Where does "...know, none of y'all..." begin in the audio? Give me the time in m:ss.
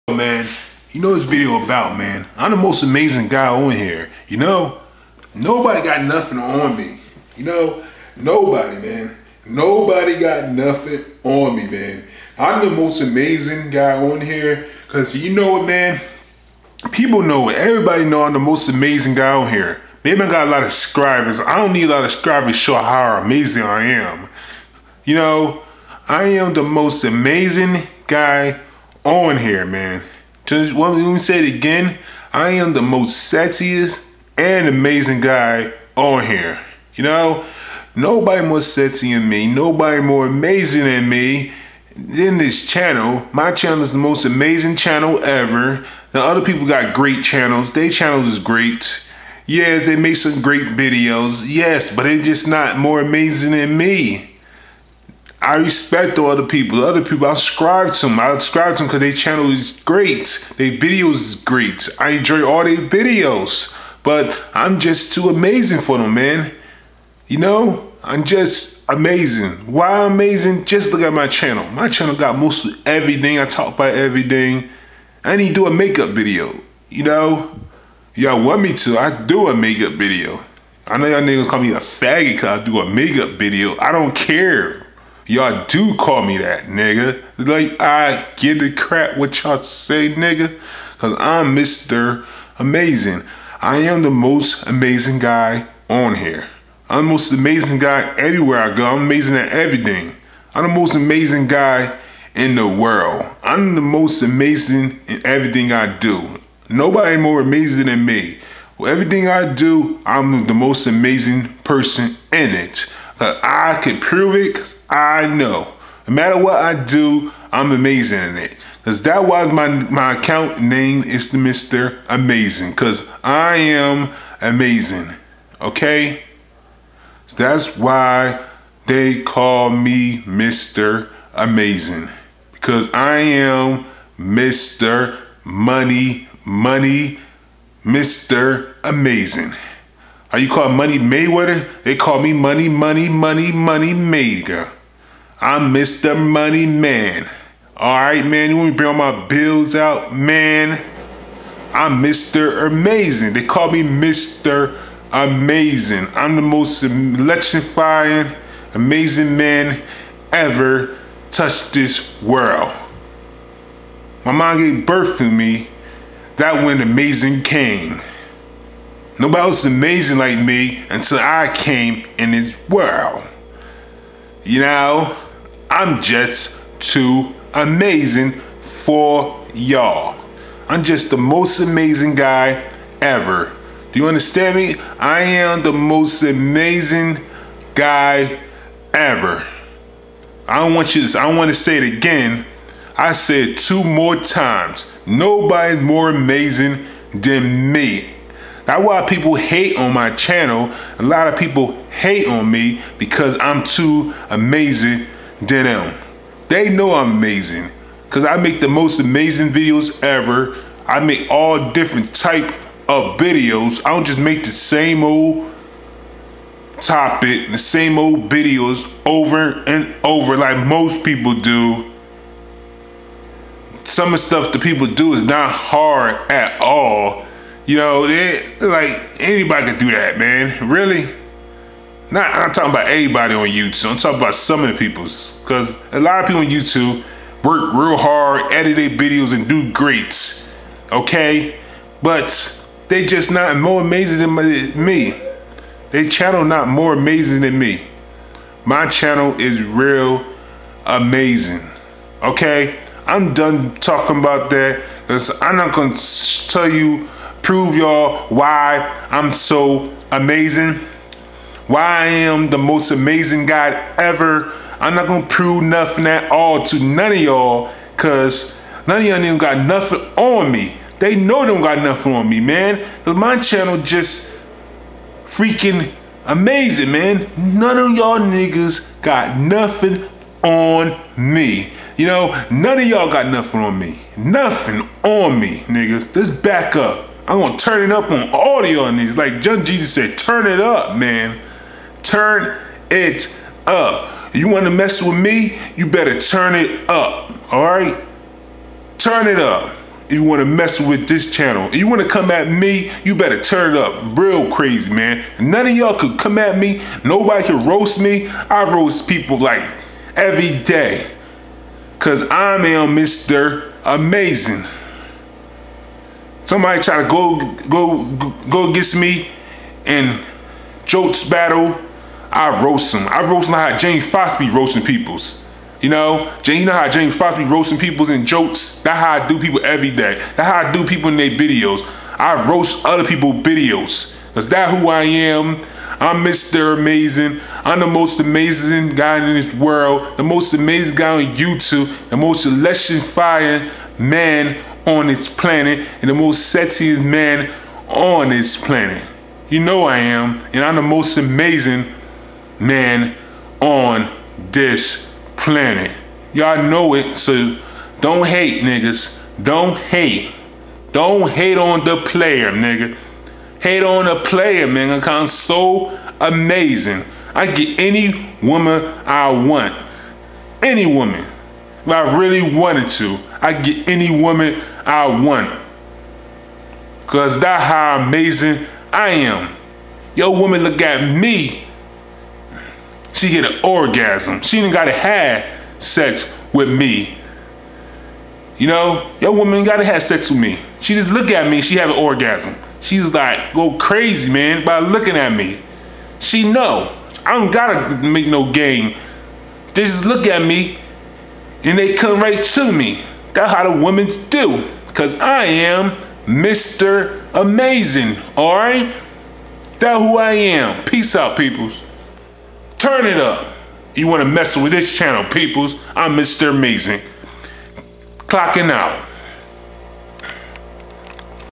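4:42.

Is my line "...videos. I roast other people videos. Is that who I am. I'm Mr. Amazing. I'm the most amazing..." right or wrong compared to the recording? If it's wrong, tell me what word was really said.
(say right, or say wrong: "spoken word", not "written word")
right.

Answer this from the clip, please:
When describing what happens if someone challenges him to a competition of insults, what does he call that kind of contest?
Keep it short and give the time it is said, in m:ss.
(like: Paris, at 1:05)
Jokes battle, at 5:20.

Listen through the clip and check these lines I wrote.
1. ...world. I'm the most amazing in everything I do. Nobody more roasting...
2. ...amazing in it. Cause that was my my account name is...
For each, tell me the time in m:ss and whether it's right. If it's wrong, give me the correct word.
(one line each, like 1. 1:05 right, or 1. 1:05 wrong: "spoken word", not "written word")
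1. 1:42 wrong: "amazing", not "roasting"
2. 1:57 right.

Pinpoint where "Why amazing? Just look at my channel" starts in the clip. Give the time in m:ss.
1:09.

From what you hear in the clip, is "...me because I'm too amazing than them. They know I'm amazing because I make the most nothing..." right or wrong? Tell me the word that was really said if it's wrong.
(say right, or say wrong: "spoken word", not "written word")
wrong: "amazing", not "nothing".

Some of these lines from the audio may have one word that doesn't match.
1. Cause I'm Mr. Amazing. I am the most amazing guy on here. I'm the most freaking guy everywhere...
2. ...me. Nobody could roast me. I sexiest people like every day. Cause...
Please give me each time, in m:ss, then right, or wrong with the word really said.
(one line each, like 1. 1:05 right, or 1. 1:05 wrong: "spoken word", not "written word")
1. 1:30 wrong: "amazing", not "freaking"
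2. 5:06 wrong: "roast", not "sexiest".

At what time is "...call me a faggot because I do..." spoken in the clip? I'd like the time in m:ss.
1:21.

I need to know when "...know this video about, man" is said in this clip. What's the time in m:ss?
0:01.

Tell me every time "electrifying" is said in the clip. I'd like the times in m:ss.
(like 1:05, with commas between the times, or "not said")
2:36, 5:42.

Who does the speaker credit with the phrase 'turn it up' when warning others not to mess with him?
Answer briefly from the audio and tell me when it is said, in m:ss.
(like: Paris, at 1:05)
John Jesus, at 4:49.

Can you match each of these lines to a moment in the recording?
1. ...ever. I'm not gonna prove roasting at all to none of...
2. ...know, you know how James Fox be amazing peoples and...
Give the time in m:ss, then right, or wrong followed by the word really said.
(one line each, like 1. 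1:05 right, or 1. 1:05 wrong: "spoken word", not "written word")
1. 4:23 wrong: "nothing", not "roasting"
2. 5:25 wrong: "roasting", not "amazing".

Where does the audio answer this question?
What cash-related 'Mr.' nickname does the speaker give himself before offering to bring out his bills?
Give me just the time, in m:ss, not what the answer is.
2:25.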